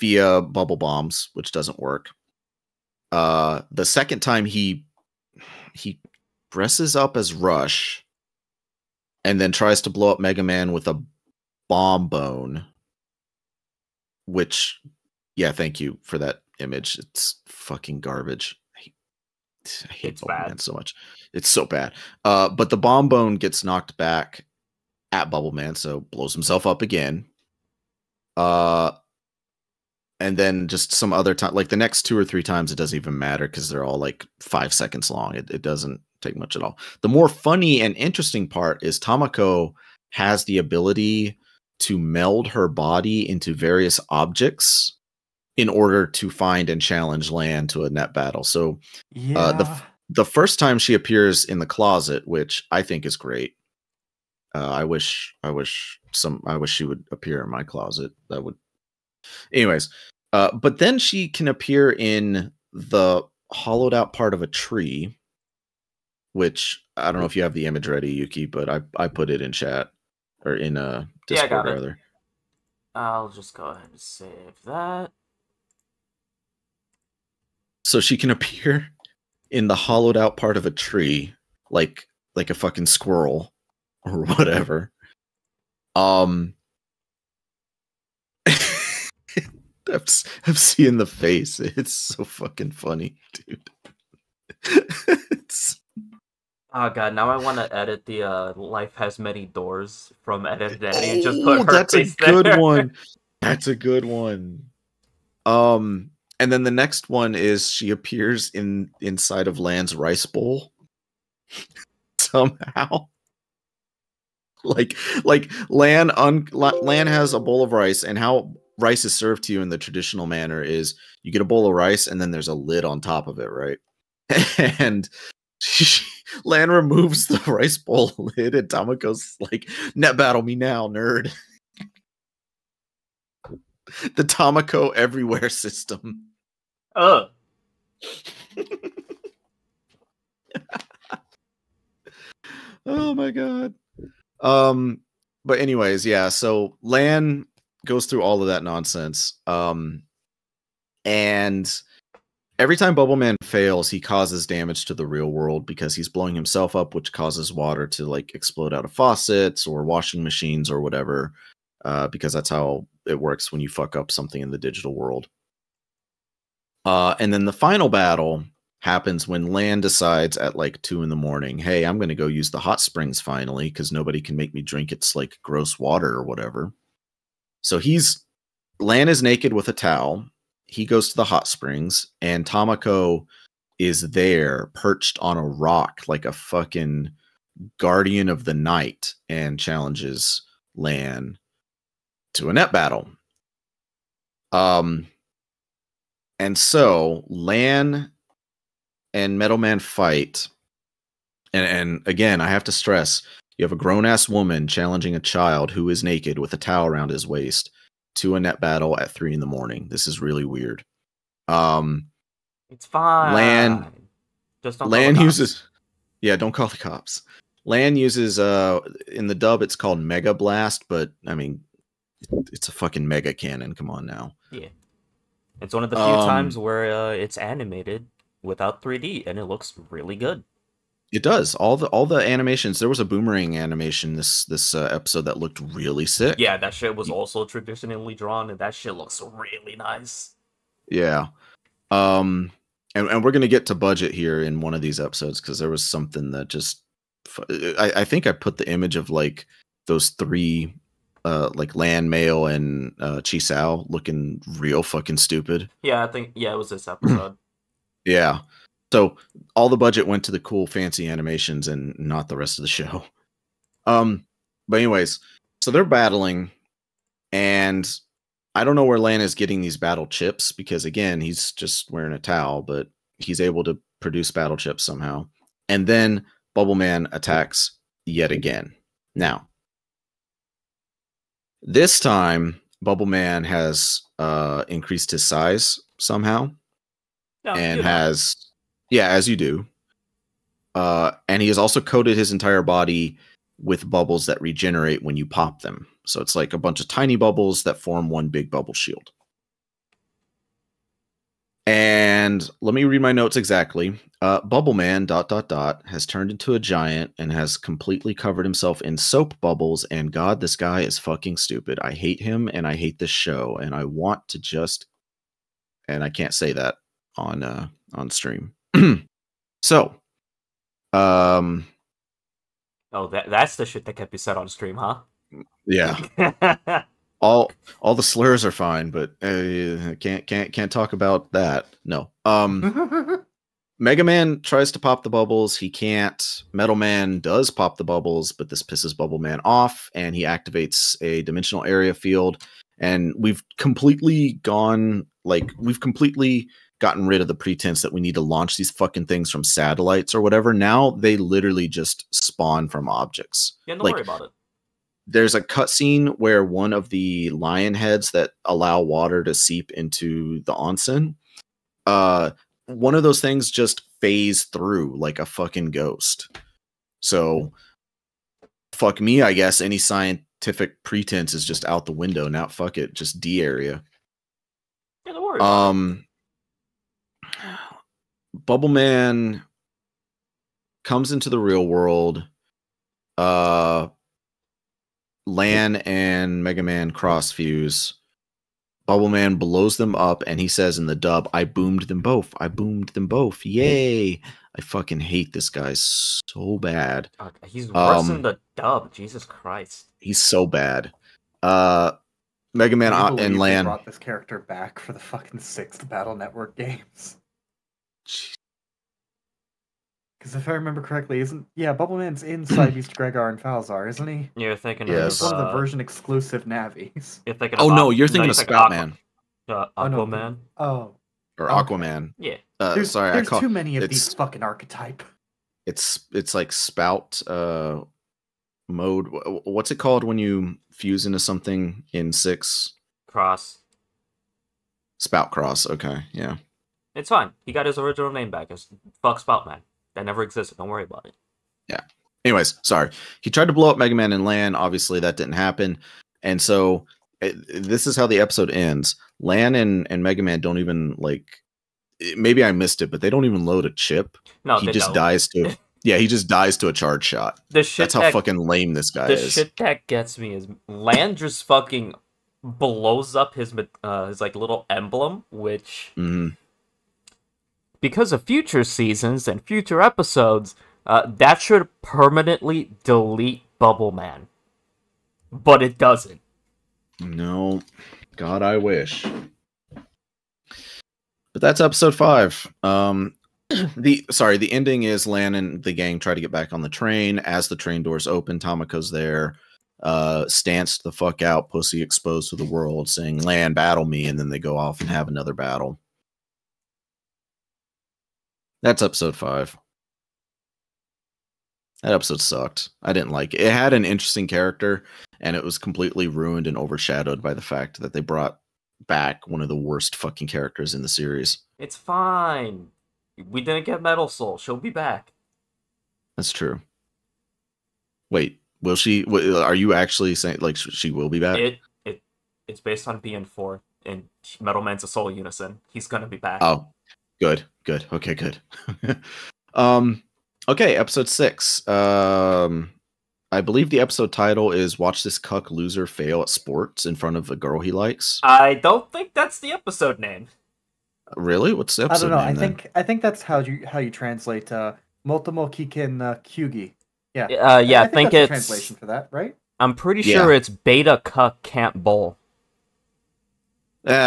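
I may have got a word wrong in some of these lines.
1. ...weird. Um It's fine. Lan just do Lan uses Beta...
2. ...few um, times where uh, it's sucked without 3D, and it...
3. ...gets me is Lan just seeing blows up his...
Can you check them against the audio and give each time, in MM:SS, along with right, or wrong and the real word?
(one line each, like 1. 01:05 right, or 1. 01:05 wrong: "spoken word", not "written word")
1. 03:30 wrong: "Yeah", not "Beta"
2. 03:45 wrong: "animated", not "sucked"
3. 07:39 wrong: "fucking", not "seeing".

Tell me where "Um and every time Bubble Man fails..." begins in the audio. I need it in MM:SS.
02:29.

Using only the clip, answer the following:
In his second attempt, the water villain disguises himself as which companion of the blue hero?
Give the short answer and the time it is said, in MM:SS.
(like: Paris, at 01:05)
Rush, at 00:07.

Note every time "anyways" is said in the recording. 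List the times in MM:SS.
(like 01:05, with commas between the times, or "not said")
00:59, 02:25, 04:24, 07:22.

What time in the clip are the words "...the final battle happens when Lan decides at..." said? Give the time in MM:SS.
02:47.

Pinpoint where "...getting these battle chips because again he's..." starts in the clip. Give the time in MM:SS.
04:29.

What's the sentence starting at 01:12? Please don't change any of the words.
I'll just go ahead and save that.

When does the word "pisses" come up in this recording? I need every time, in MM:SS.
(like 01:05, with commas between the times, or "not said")
05:38.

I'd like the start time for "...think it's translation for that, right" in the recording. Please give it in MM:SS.
09:08.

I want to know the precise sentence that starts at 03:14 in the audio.
Um, and so Lan and Metal Man fight.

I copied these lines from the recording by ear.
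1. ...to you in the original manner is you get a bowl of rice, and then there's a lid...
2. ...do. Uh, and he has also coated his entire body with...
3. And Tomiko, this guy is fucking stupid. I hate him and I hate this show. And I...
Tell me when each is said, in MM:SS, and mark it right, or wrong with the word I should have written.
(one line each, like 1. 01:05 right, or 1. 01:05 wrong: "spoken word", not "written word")
1. 01:59 wrong: "traditional", not "original"
2. 04:49 right
3. 05:09 wrong: "God", not "Tomiko".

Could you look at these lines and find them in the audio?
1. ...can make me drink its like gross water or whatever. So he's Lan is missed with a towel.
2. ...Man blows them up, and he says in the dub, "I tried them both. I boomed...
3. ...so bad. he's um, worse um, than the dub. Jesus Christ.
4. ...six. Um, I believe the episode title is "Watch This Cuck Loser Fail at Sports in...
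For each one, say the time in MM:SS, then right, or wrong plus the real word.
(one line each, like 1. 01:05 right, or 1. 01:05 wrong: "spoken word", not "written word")
1. 02:54 wrong: "naked", not "missed"
2. 06:29 wrong: "boomed", not "tried"
3. 06:35 right
4. 08:51 right.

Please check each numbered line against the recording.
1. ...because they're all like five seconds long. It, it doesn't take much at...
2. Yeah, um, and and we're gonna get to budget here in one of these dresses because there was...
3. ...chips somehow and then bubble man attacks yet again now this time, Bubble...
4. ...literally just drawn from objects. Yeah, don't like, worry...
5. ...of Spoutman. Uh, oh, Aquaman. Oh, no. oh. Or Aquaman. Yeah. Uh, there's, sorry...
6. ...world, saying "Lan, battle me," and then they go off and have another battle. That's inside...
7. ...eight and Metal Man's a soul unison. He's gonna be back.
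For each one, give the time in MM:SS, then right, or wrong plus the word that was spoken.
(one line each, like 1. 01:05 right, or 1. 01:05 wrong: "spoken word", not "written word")
1. 00:33 right
2. 04:00 wrong: "episodes", not "dresses"
3. 04:34 right
4. 05:51 wrong: "spawn", not "drawn"
5. 06:58 right
6. 08:12 wrong: "episode", not "inside"
7. 08:43 wrong: "four", not "eight".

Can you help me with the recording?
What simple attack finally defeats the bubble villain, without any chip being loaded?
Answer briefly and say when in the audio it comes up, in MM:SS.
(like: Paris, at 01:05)
a charge shot, at 07:36.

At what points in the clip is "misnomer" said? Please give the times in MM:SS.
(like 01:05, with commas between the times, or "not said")
not said.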